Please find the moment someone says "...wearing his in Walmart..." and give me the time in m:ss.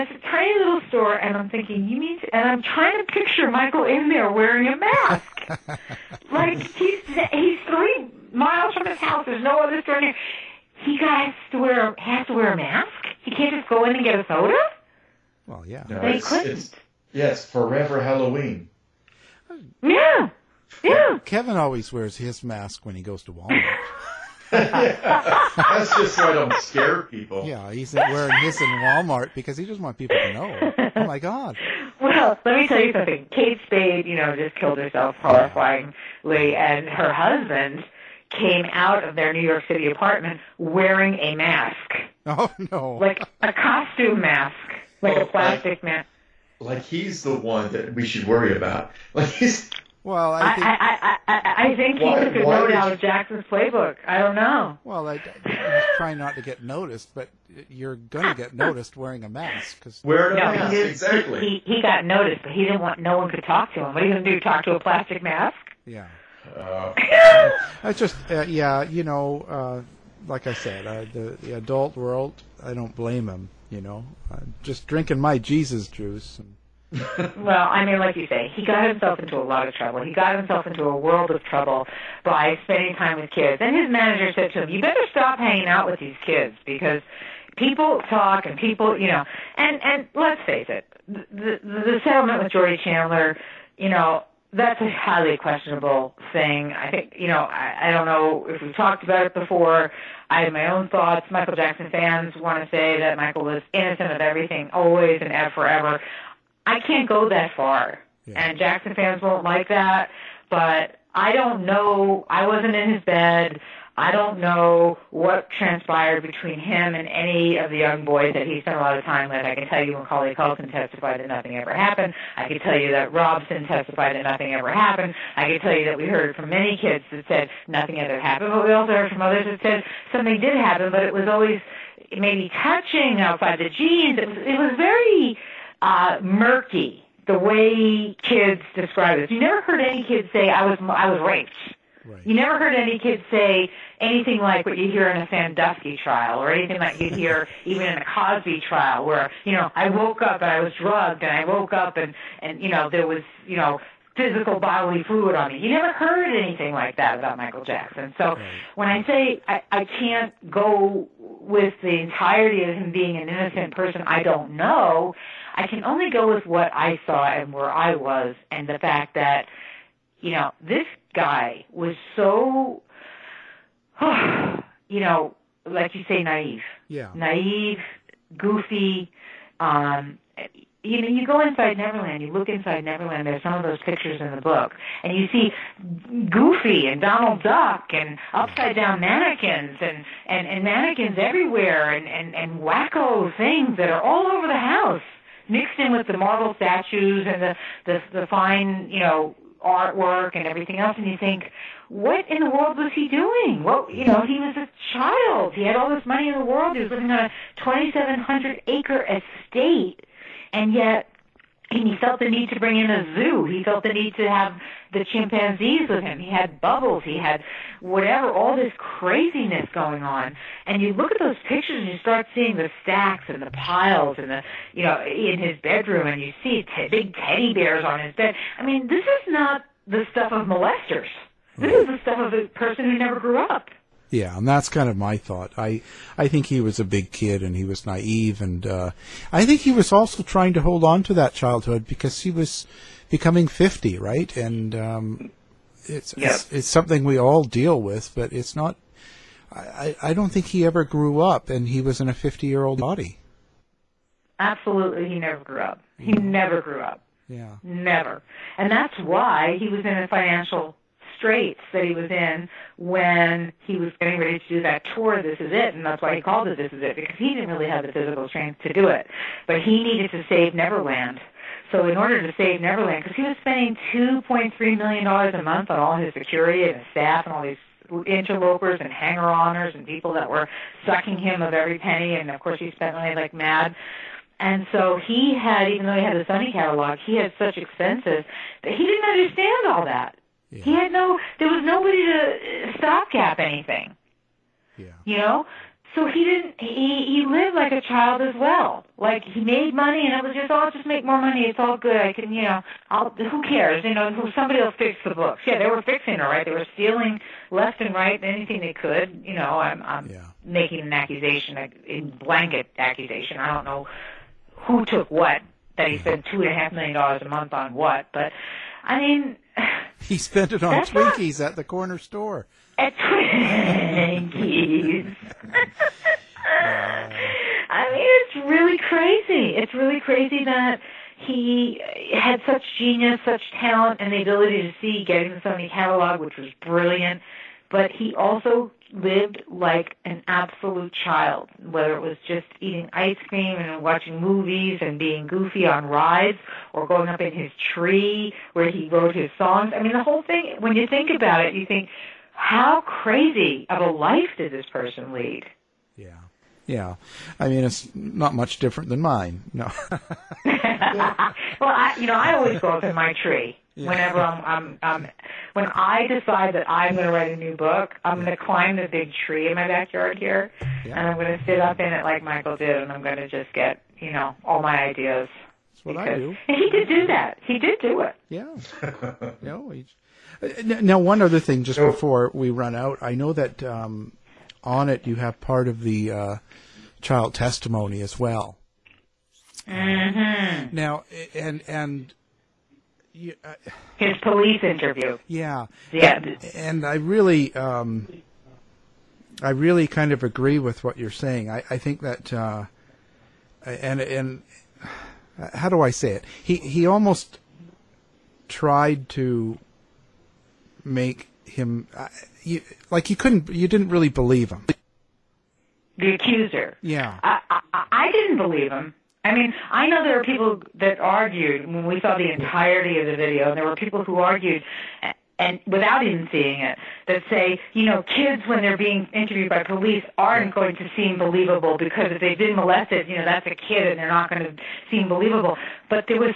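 0:27.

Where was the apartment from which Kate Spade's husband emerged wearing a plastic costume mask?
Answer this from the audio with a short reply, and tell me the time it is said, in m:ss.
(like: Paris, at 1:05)
New York City, at 0:39.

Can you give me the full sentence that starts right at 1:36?
I think, you know, I, I don't know if we've talked about it before.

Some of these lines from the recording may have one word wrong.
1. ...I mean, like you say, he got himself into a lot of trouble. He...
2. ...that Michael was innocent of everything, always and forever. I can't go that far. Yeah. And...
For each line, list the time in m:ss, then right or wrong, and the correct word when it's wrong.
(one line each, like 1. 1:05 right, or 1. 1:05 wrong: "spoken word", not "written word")
1. 1:17 right
2. 1:42 right.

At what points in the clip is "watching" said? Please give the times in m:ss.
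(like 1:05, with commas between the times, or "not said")
5:43.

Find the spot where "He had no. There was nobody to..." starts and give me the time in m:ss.
4:50.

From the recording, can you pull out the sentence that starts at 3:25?
He had all this money in the world.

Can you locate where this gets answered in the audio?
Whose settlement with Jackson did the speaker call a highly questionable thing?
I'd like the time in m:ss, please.
1:32.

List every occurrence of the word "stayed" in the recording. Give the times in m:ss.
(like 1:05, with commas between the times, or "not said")
not said.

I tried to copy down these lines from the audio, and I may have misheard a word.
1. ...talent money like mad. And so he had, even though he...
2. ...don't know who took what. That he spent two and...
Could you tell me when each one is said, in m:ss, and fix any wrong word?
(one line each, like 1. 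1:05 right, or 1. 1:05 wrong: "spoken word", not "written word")
1. 4:42 wrong: "spent", not "talent"
2. 5:13 right.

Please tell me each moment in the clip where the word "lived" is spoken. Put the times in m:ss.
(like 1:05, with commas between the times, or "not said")
4:57, 5:38.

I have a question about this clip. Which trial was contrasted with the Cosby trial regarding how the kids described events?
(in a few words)
Sandusky.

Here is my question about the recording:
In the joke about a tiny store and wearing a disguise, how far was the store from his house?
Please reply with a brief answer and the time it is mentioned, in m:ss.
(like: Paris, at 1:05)
3 miles, at 0:07.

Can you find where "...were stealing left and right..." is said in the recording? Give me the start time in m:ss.
5:06.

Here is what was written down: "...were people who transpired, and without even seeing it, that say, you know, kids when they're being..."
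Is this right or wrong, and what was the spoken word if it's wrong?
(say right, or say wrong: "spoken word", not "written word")
wrong: "argued", not "transpired".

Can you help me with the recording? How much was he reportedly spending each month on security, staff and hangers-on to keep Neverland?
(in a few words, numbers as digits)
$2.3 million.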